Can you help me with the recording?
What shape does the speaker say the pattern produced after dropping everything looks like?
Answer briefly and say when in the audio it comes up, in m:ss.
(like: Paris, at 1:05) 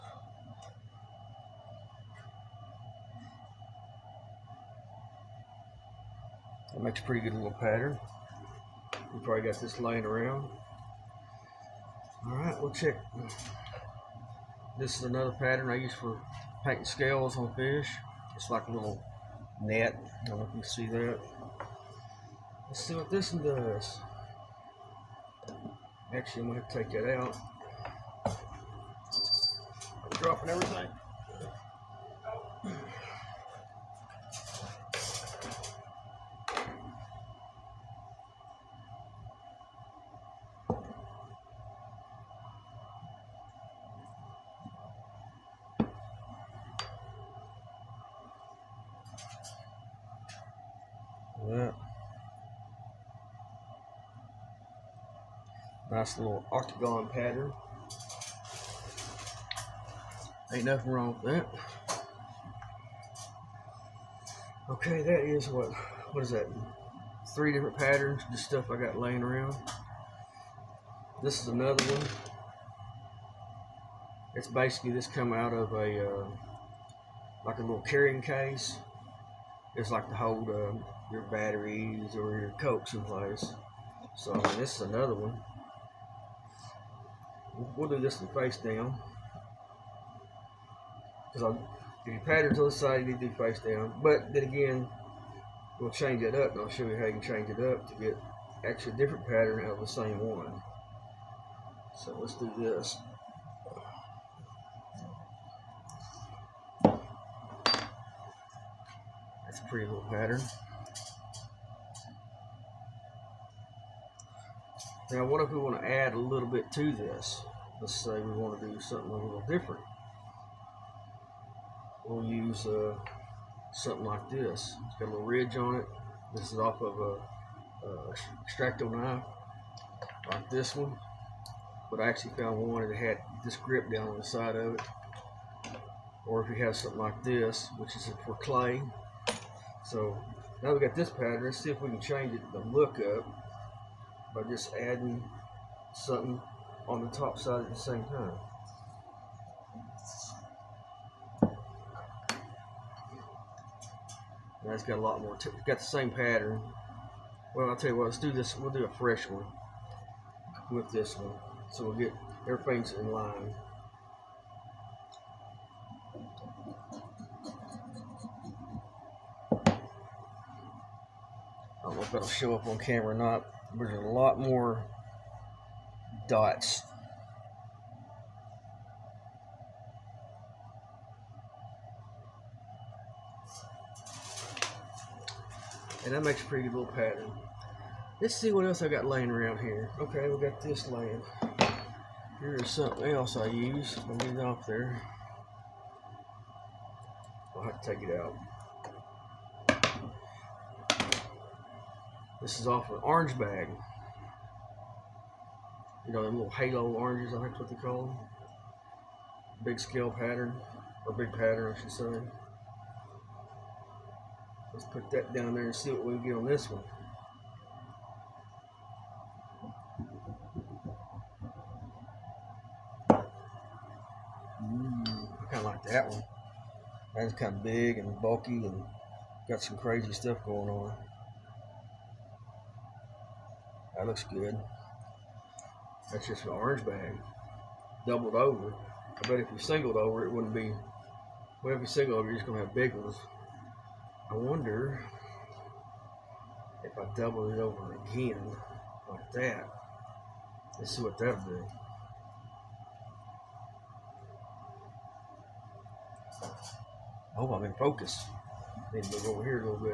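Octagon, at 0:56.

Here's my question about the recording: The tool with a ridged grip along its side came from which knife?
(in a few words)
Extracto knife.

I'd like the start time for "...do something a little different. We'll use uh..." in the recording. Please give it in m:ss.
1:58.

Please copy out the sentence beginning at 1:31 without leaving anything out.
Because if you pattern to the side, you need do face down.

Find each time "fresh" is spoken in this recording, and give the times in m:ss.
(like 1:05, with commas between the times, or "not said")
2:38.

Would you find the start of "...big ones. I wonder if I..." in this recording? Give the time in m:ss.
4:02.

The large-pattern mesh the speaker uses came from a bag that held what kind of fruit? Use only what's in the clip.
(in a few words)
Halo oranges.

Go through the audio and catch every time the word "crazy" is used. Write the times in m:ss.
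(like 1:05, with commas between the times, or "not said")
3:49.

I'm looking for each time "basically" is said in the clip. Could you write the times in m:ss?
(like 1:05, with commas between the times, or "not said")
1:14.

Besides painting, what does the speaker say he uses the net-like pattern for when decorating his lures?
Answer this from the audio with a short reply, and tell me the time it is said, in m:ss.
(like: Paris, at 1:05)
Scales on fish, at 0:16.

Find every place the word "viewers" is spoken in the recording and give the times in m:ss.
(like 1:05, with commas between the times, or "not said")
not said.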